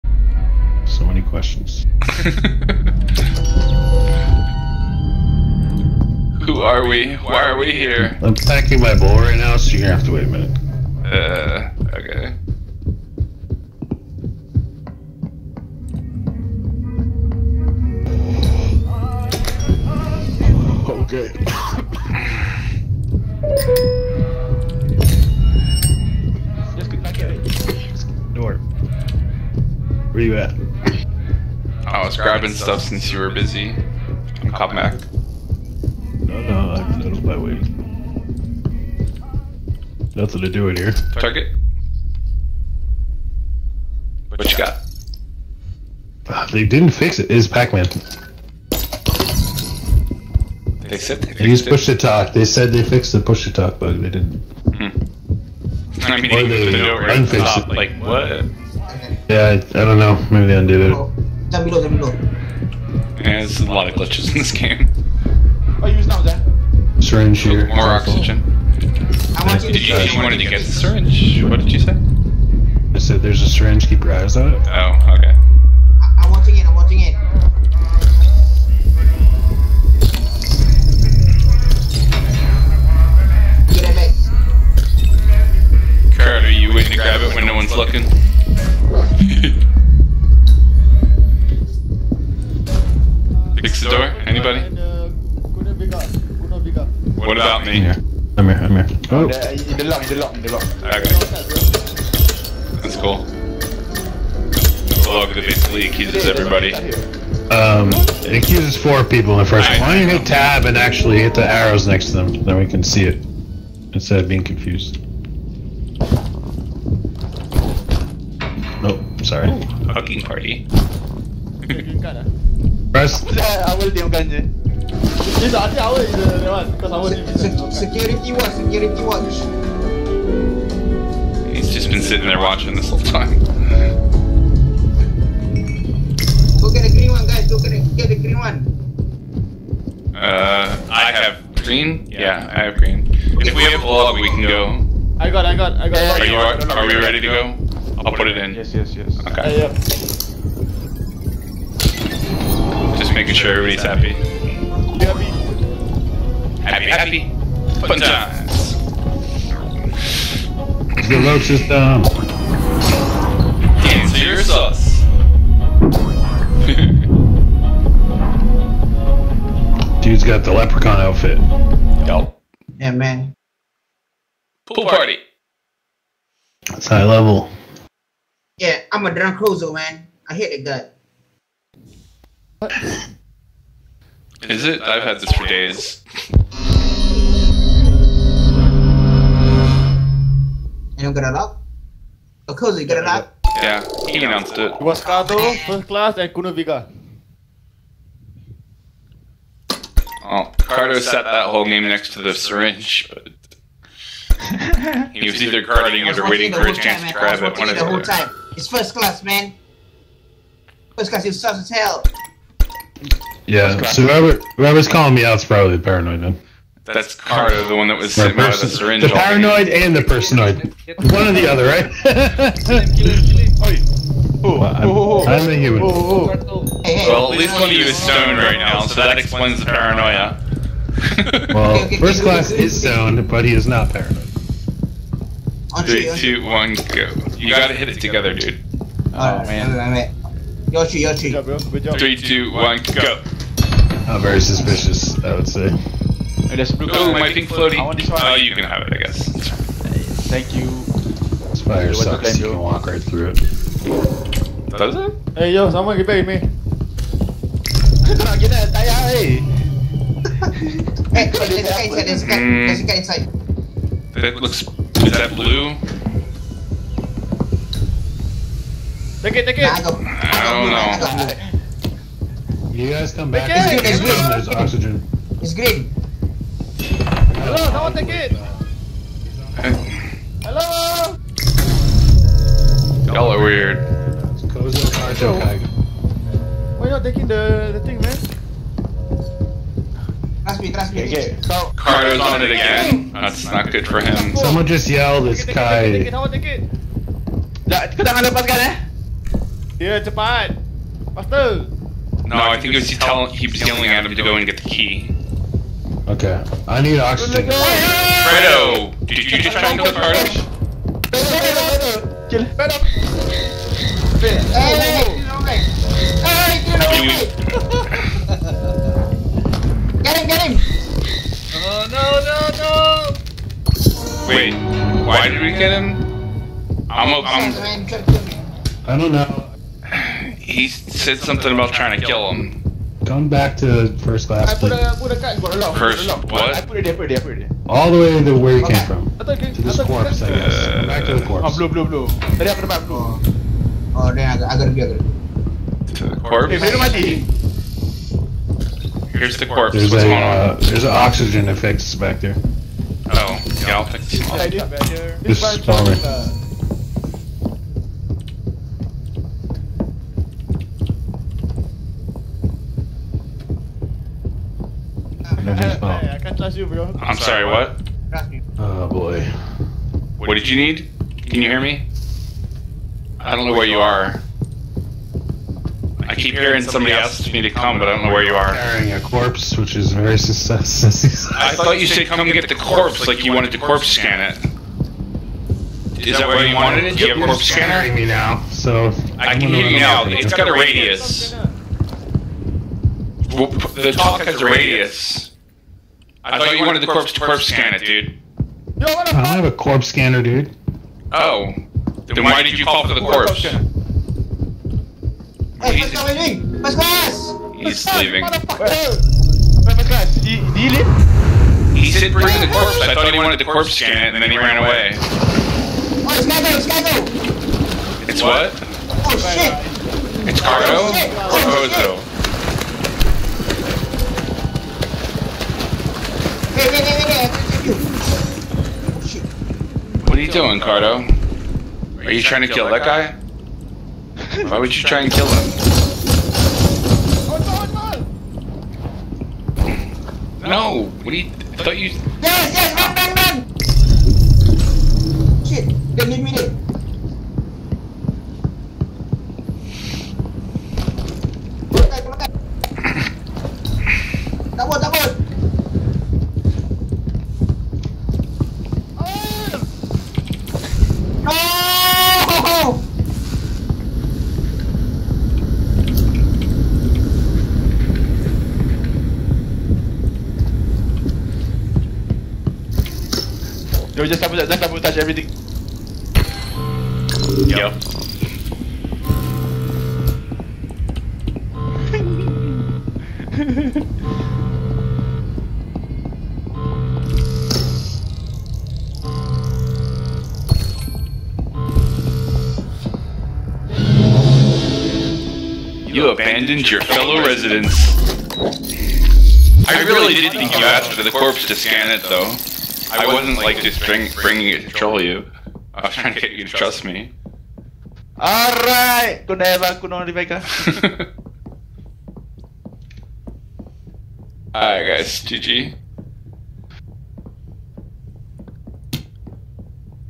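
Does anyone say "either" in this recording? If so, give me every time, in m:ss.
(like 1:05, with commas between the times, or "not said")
3:25.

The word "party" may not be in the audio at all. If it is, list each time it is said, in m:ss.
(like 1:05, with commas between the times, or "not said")
2:00, 2:54.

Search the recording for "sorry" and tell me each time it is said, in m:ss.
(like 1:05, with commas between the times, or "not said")
1:59, 6:07.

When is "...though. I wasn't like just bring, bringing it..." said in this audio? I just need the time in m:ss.
8:22.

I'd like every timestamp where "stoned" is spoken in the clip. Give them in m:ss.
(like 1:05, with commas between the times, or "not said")
3:47, 3:52.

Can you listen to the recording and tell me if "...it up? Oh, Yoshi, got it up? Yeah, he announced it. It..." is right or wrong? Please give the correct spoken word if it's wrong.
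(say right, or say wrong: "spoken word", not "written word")
wrong: "Cozy", not "Yoshi".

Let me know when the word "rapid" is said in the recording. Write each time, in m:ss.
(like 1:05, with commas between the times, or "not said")
not said.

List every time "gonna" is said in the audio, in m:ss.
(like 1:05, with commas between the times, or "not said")
0:09.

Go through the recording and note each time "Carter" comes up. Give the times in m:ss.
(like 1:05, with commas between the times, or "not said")
3:37, 4:51.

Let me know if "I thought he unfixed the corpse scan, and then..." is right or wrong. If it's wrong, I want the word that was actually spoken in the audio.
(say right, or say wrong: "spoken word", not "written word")
wrong: "wanted", not "unfixed".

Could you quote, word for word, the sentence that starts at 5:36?
I put it there, put it there, put it there.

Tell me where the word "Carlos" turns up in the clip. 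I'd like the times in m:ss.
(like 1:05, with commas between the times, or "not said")
5:09.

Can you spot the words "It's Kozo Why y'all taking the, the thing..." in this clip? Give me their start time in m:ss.
4:44.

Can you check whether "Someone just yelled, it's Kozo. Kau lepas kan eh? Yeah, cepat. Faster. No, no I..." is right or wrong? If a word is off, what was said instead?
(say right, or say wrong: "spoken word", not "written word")
wrong: "Kai", not "Kozo".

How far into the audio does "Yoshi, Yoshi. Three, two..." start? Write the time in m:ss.
4:00.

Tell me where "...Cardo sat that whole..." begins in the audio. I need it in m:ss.
3:20.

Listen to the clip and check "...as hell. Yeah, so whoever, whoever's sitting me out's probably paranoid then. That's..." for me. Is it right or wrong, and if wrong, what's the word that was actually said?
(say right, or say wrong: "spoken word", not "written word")
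wrong: "calling", not "sitting".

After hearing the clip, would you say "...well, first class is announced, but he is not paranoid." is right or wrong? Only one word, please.
wrong.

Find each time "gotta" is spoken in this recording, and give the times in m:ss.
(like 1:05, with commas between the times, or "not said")
3:57, 5:44.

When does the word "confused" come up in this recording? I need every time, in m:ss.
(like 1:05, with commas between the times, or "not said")
1:54.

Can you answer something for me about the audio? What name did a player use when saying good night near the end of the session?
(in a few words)
Rebecca.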